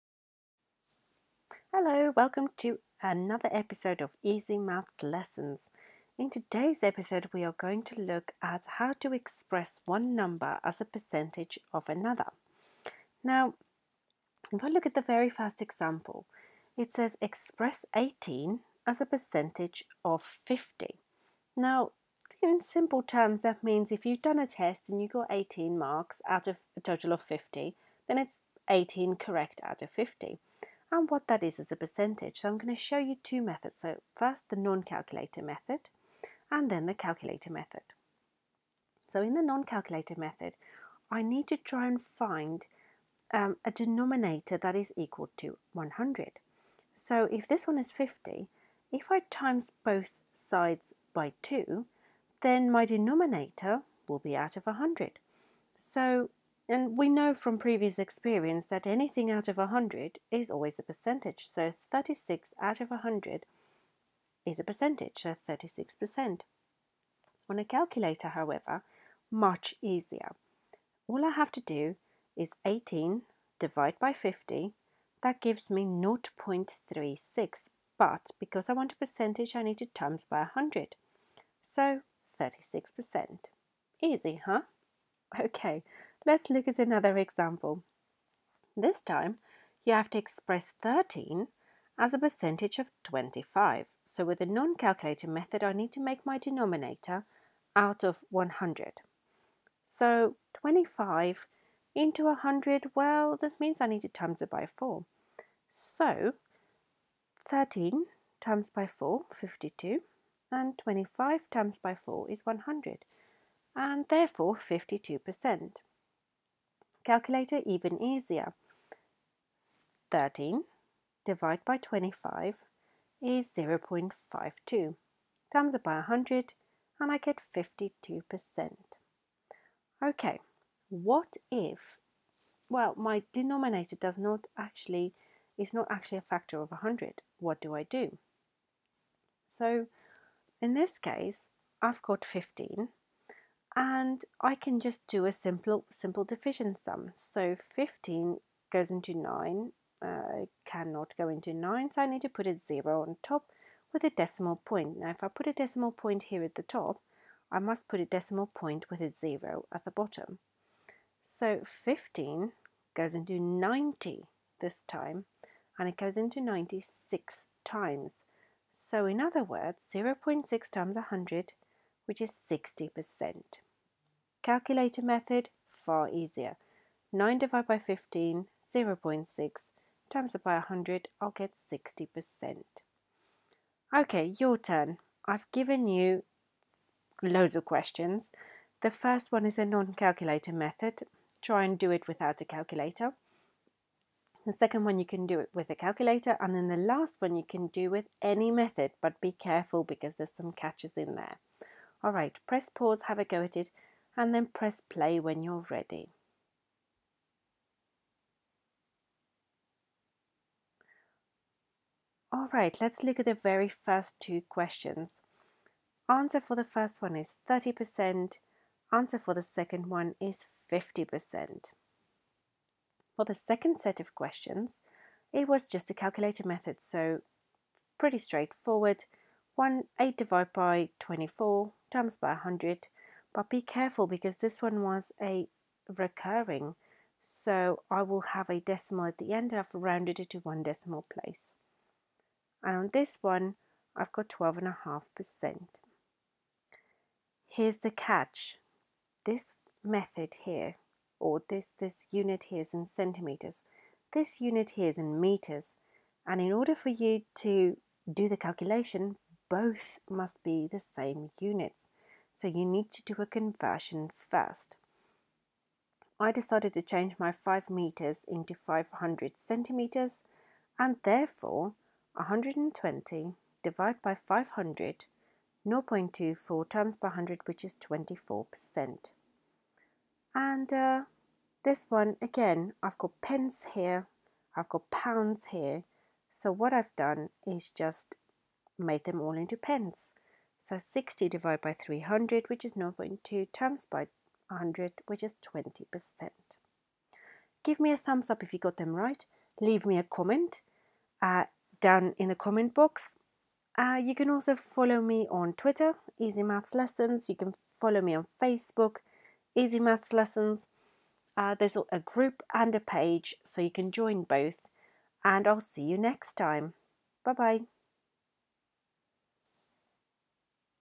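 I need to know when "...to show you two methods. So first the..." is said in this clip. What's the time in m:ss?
0:32.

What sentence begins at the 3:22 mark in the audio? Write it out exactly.
All right, press pause, have a go at it, and then press play when you're ready.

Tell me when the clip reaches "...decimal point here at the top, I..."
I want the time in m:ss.
2:35.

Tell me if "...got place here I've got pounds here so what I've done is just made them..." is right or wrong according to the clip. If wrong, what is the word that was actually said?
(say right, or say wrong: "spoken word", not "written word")
wrong: "pence", not "place".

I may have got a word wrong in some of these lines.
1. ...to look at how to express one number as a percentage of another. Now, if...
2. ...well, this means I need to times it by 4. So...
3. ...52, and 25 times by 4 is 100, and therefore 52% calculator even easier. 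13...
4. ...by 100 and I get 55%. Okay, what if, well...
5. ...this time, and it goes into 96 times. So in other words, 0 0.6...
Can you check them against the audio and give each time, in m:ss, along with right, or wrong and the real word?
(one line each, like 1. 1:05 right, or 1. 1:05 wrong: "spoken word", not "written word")
1. 0:07 right
2. 1:42 right
3. 1:49 right
4. 2:05 wrong: "52", not "55"
5. 2:44 right.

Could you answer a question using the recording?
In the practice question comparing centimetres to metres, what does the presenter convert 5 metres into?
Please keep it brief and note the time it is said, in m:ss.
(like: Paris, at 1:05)
500 centimeters, at 4:28.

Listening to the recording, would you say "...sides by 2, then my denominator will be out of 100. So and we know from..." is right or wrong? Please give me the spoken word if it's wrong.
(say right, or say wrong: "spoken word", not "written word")
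right.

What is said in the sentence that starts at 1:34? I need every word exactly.
So with the non-calculator method, I need to make my denominator out of 100.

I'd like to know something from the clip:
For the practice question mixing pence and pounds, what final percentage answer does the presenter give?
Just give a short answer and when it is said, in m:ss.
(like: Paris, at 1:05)
20%, at 4:55.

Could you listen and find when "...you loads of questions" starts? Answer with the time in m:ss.
3:05.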